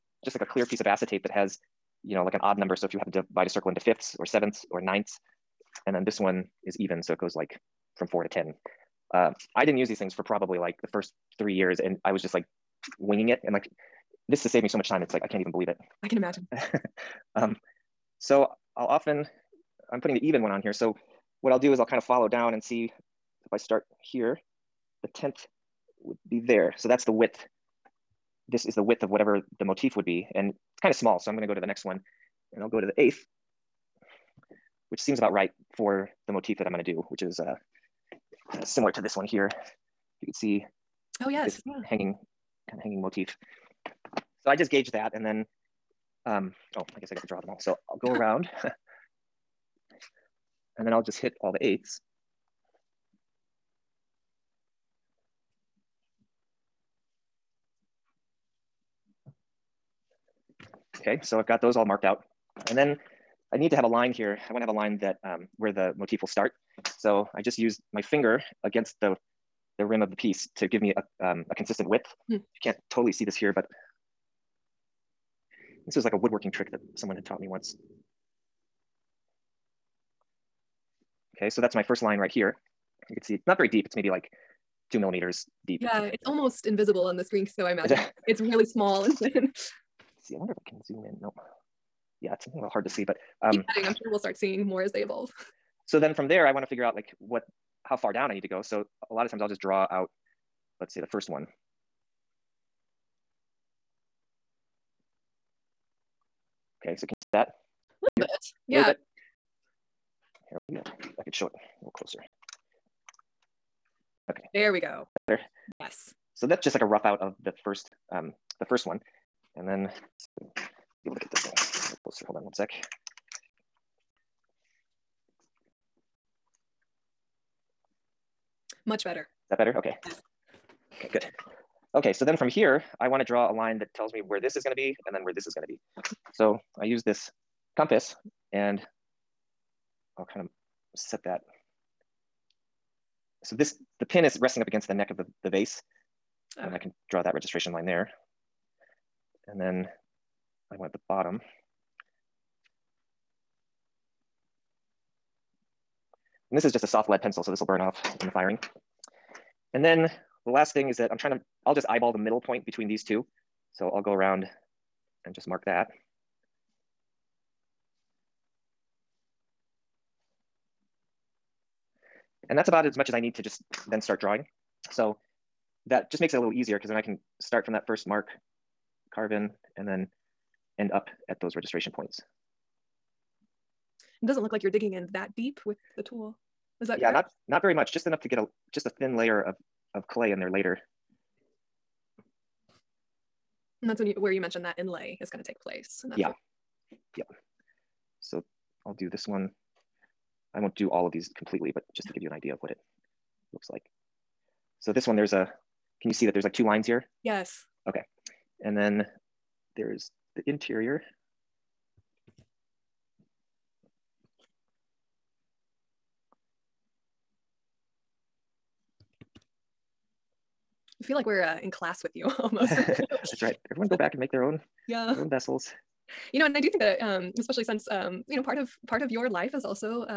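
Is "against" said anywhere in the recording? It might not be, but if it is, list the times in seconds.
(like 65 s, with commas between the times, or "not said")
68 s, 144 s.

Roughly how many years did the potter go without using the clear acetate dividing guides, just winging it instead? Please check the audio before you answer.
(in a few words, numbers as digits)
3.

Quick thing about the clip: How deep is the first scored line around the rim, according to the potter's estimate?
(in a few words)
2 millimeters.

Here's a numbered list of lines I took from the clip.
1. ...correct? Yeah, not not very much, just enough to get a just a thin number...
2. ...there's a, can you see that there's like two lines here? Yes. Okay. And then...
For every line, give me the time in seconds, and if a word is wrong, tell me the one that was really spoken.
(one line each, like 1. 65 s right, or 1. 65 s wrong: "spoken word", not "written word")
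1. 186 s wrong: "layer", not "number"
2. 205 s right.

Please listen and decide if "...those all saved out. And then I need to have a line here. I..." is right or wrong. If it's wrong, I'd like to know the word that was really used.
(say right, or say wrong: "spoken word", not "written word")
wrong: "marked", not "saved".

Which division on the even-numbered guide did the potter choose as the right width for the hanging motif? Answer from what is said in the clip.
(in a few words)
eighth.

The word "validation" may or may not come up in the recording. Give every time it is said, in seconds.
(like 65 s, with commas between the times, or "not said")
not said.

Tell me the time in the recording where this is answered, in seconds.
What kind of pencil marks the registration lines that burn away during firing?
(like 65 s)
156 s.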